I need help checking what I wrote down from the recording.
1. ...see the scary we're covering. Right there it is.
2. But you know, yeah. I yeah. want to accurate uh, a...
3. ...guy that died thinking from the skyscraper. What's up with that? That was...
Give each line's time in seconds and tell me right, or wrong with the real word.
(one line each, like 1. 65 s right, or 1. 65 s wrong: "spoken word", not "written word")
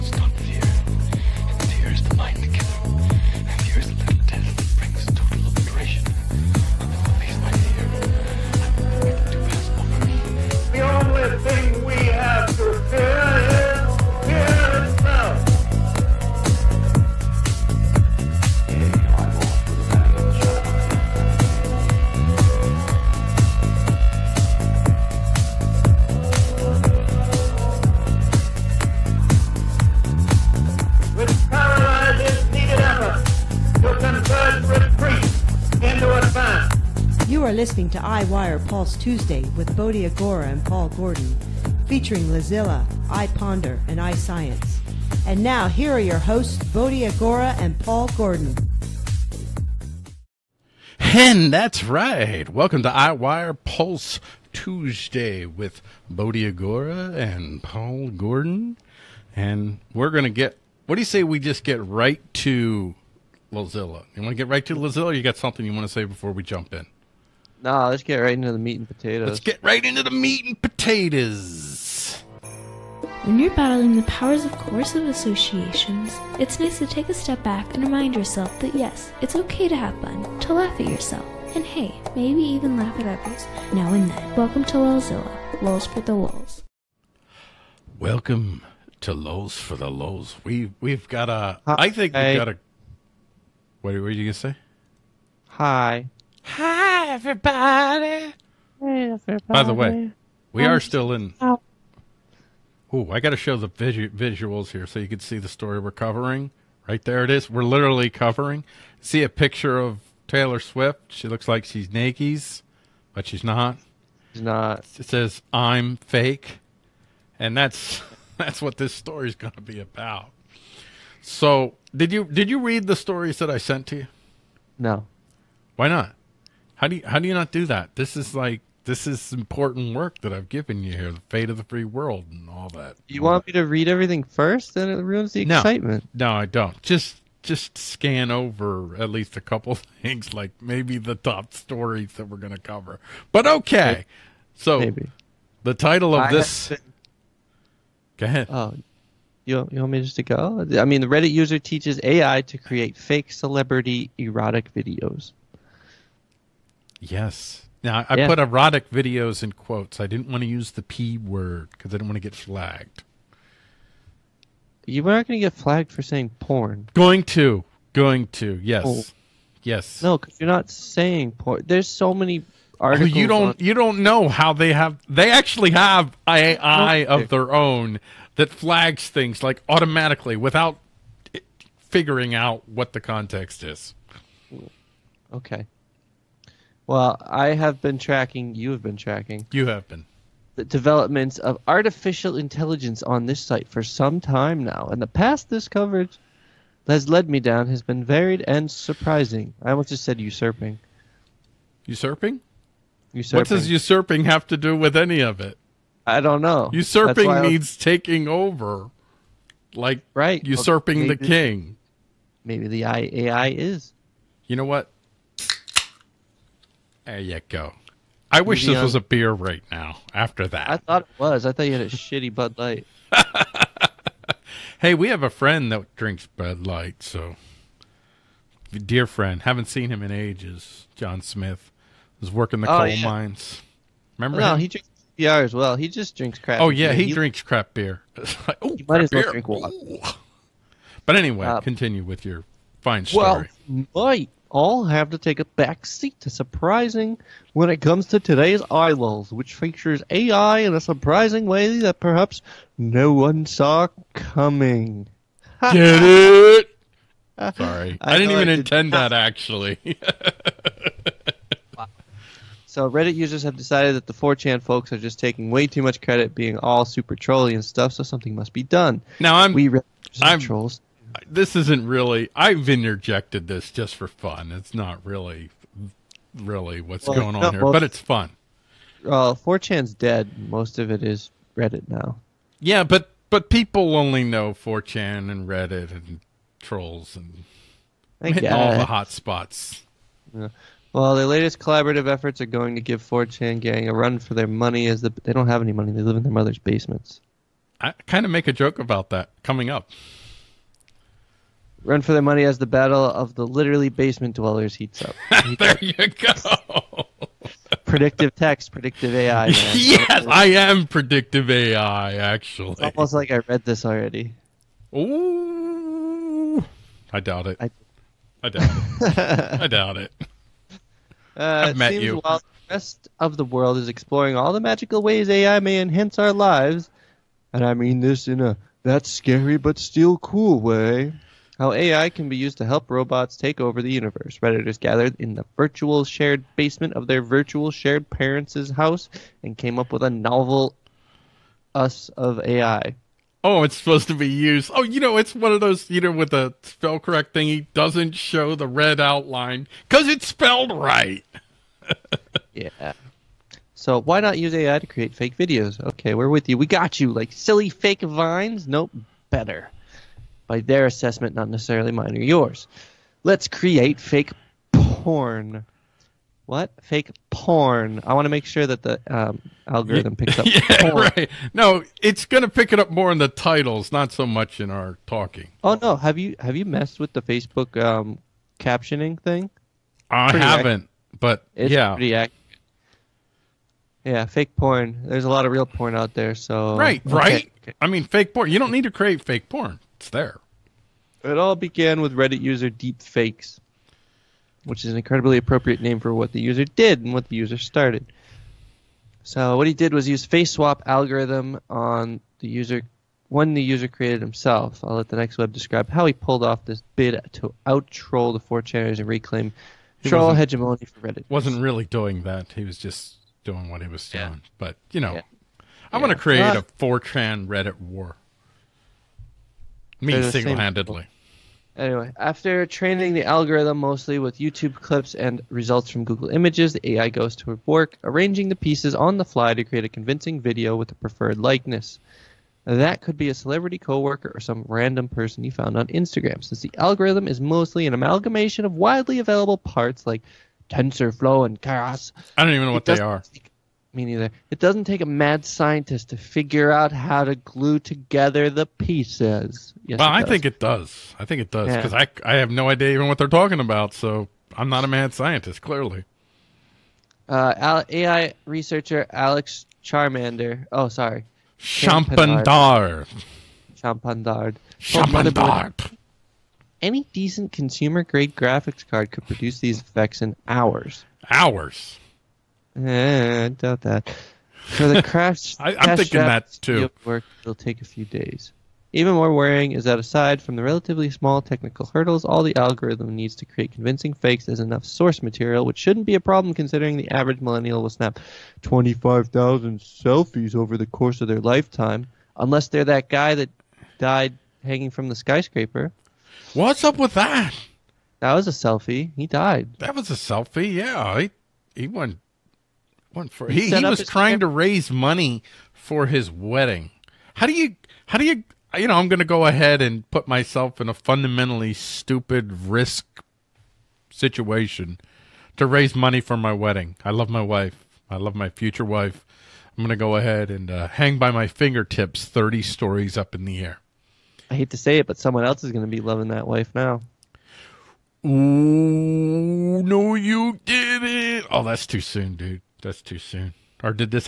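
1. 105 s wrong: "story", not "scary"
2. 414 s wrong: "create", not "accurate"
3. 493 s wrong: "hanging", not "thinking".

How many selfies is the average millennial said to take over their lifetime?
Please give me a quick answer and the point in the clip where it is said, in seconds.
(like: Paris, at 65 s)
25,000, at 488 s.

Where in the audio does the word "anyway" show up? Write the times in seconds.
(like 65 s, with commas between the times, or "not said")
241 s, 421 s.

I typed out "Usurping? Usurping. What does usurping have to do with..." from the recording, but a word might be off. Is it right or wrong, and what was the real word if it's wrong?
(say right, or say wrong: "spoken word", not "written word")
right.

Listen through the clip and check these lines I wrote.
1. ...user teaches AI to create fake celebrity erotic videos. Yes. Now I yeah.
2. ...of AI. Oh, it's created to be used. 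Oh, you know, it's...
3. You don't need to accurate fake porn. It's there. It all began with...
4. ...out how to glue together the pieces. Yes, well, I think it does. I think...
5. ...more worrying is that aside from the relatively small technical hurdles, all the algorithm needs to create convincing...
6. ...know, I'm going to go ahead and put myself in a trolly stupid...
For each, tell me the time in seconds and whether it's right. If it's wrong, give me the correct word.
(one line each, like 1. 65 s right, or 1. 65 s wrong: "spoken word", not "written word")
1. 151 s right
2. 342 s wrong: "supposed", not "created"
3. 388 s wrong: "create", not "accurate"
4. 446 s right
5. 479 s right
6. 508 s wrong: "fundamentally", not "trolly".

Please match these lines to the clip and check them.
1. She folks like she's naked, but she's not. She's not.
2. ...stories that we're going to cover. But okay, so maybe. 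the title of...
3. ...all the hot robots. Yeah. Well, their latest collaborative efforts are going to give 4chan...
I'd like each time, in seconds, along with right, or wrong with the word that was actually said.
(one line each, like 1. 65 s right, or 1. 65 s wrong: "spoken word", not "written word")
1. 111 s wrong: "looks", not "folks"
2. 141 s right
3. 288 s wrong: "spots", not "robots".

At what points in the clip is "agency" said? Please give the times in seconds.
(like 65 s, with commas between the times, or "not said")
not said.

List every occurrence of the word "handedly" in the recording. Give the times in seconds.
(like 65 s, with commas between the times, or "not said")
420 s.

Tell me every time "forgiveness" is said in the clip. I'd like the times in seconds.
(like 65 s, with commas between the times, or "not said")
not said.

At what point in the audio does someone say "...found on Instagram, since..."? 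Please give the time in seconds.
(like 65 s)
435 s.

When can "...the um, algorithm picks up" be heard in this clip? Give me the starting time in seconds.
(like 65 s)
368 s.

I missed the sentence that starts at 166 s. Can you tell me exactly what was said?
Going to, going to, yes, oh.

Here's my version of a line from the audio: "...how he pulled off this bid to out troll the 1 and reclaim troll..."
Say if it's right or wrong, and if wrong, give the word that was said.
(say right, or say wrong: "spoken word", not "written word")
wrong: "4", not "1".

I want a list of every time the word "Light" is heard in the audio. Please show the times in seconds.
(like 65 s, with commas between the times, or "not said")
222 s, 226 s.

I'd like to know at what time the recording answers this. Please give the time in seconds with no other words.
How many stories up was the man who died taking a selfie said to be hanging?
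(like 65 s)
522 s.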